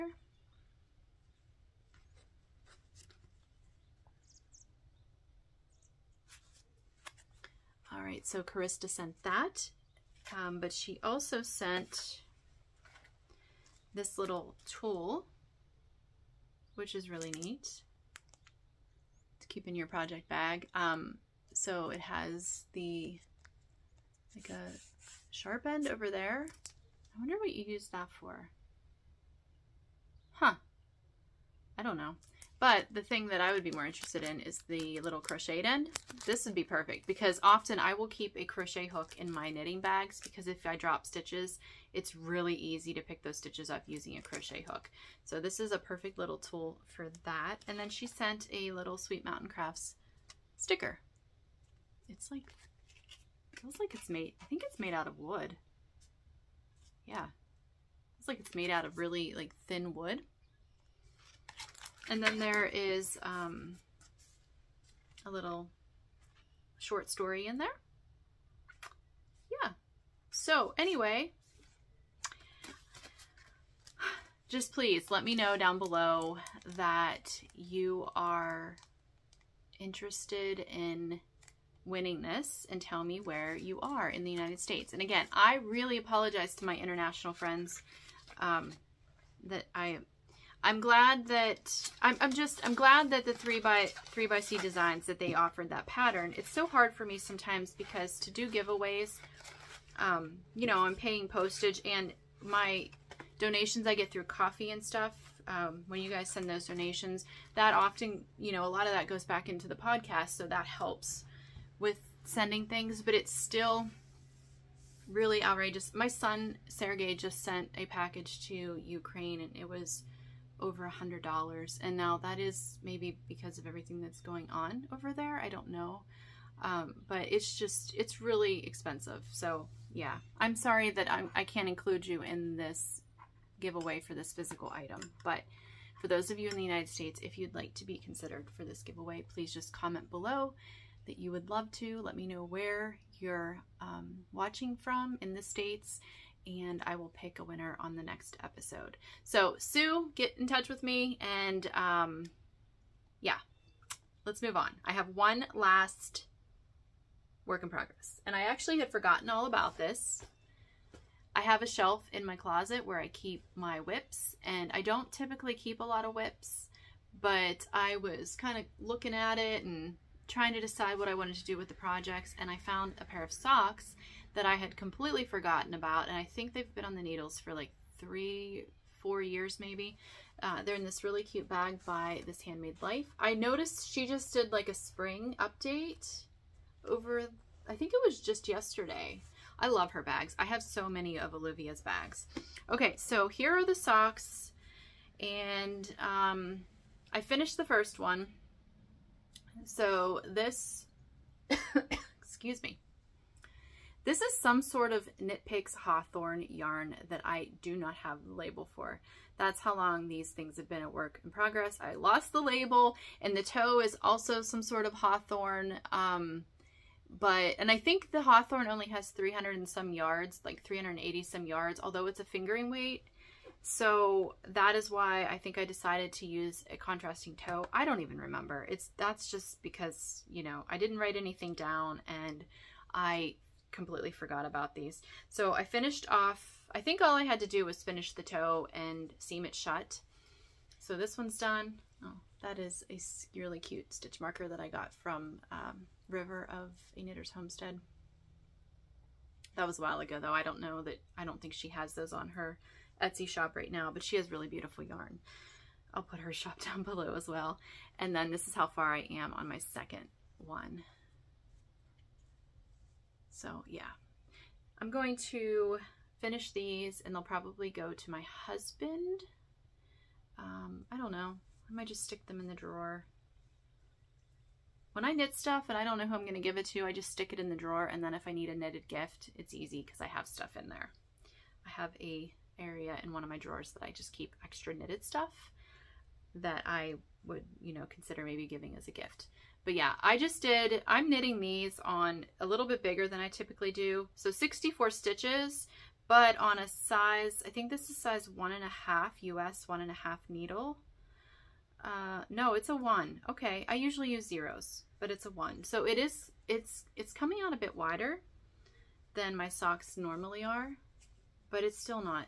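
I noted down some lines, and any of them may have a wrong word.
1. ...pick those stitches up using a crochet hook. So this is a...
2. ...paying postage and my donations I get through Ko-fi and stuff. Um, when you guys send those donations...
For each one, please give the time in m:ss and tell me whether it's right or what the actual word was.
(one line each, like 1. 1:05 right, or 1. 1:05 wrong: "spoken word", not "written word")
1. 0:43 right
2. 1:40 right.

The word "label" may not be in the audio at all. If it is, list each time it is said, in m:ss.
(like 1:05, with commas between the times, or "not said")
3:28, 3:32.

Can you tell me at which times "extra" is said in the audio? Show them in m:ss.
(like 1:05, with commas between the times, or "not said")
4:44.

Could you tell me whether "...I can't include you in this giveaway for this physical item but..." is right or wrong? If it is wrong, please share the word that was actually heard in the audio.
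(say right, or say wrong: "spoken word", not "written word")
right.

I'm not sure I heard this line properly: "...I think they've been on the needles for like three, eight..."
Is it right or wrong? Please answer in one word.
wrong.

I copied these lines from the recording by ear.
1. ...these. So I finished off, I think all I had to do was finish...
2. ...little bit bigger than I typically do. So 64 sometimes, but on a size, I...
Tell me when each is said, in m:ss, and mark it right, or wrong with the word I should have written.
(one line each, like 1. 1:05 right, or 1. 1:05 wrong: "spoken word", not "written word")
1. 3:54 right
2. 4:52 wrong: "stitches", not "sometimes".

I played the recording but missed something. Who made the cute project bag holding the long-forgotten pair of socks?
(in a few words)
This Handmade Life.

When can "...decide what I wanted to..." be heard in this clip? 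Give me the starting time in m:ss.
2:50.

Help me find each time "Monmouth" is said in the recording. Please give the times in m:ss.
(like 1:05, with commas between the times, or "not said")
not said.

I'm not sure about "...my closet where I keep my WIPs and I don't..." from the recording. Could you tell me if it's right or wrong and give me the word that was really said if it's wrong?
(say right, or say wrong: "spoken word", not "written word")
right.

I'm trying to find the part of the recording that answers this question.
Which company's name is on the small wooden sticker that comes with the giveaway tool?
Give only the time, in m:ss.
0:48.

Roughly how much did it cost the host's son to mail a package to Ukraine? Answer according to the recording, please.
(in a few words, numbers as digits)
over $100.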